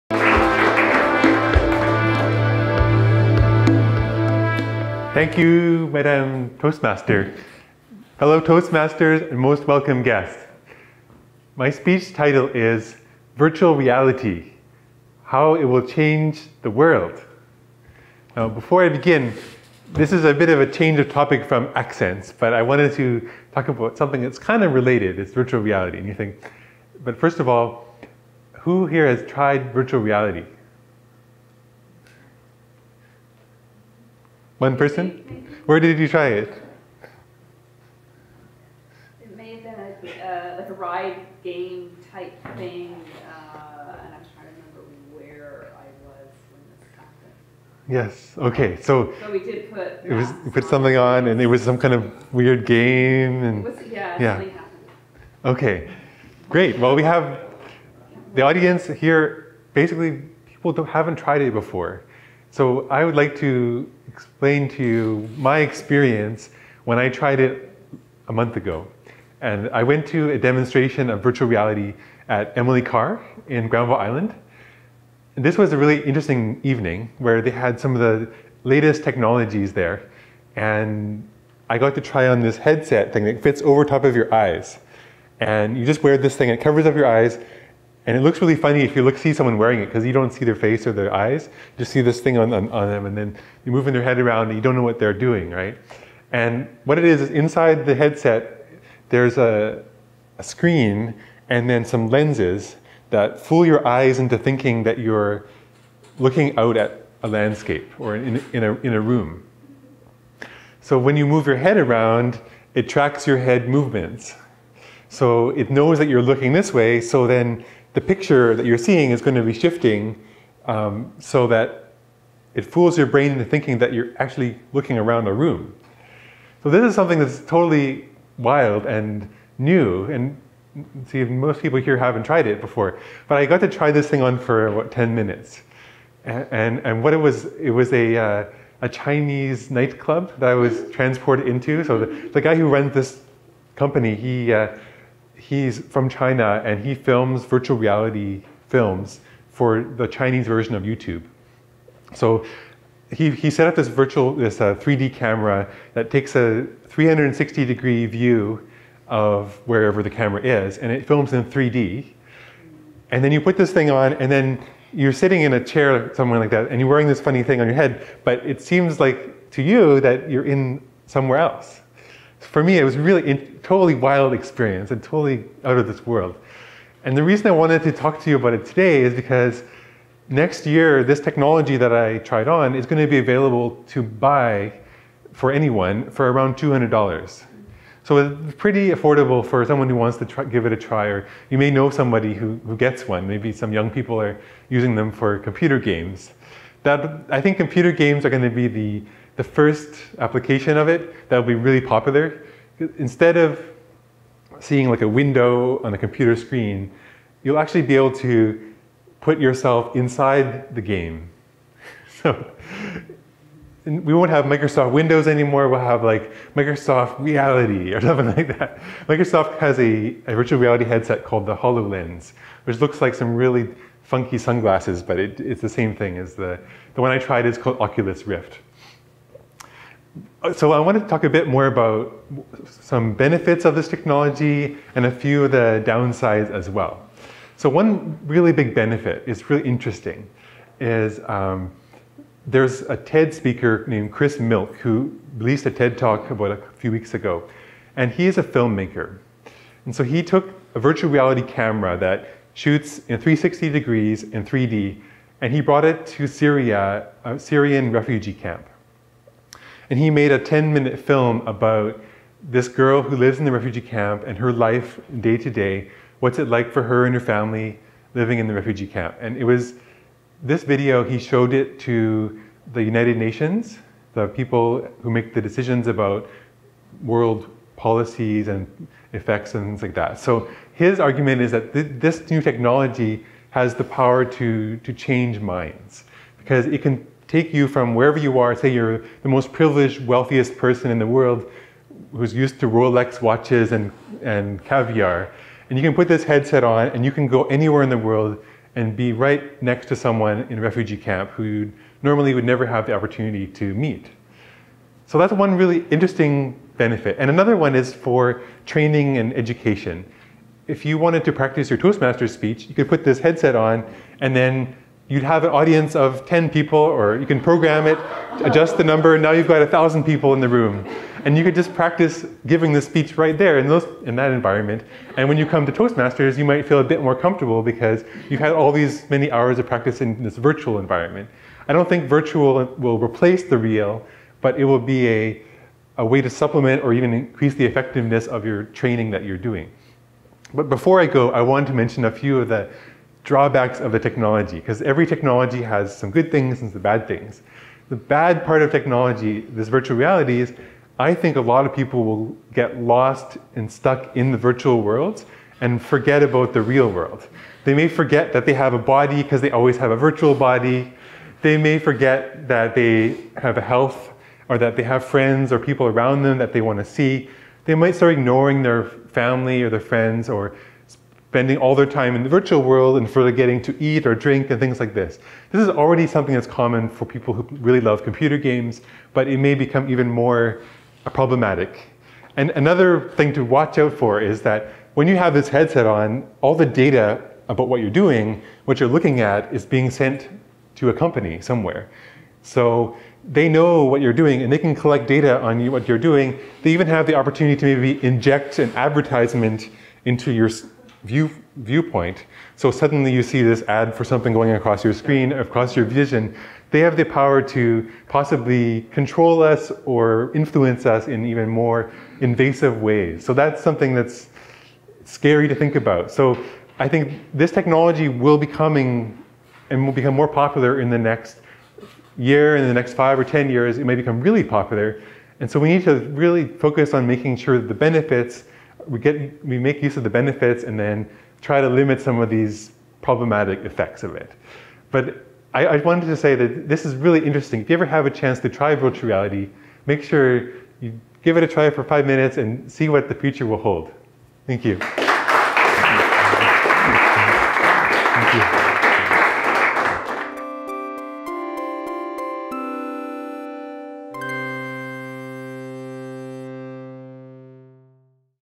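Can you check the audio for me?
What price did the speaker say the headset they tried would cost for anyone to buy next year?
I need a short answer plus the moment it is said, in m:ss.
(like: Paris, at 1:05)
$200, at 3:06.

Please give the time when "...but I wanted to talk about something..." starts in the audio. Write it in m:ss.
0:22.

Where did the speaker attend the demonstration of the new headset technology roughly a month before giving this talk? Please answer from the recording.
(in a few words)
Emily Carr in Granville Island.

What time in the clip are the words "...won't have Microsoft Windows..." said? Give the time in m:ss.
3:34.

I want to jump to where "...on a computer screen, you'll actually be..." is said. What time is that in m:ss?
3:25.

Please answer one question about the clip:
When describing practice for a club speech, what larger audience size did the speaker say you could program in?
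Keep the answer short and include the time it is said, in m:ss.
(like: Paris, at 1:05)
1,000 people, at 5:19.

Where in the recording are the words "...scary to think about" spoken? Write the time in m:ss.
6:55.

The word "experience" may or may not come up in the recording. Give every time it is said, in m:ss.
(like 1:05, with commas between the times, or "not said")
1:05, 2:54.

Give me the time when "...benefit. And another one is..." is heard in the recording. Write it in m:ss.
5:06.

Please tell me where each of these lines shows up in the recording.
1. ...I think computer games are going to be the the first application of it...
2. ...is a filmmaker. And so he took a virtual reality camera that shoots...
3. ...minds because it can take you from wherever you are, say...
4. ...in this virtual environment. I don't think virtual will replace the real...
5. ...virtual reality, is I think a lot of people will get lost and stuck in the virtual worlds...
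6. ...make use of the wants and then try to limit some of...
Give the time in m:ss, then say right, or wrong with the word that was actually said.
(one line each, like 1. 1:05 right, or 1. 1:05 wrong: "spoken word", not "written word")
1. 3:17 right
2. 4:08 right
3. 4:45 right
4. 5:29 right
5. 5:49 right
6. 7:09 wrong: "benefits", not "wants".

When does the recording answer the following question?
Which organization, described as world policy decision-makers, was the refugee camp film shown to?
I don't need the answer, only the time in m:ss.
4:32.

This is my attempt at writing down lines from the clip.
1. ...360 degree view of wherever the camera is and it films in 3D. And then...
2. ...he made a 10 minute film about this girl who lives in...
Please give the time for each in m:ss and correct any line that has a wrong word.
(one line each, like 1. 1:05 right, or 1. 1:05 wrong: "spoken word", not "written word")
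1. 2:36 right
2. 4:19 right.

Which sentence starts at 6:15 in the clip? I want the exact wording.
This is already something that's common for people who really love computer games, but it may become even more problematic.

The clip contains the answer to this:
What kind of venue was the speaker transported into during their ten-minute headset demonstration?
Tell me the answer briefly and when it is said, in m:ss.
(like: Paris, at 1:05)
Chinese nightclub, at 2:18.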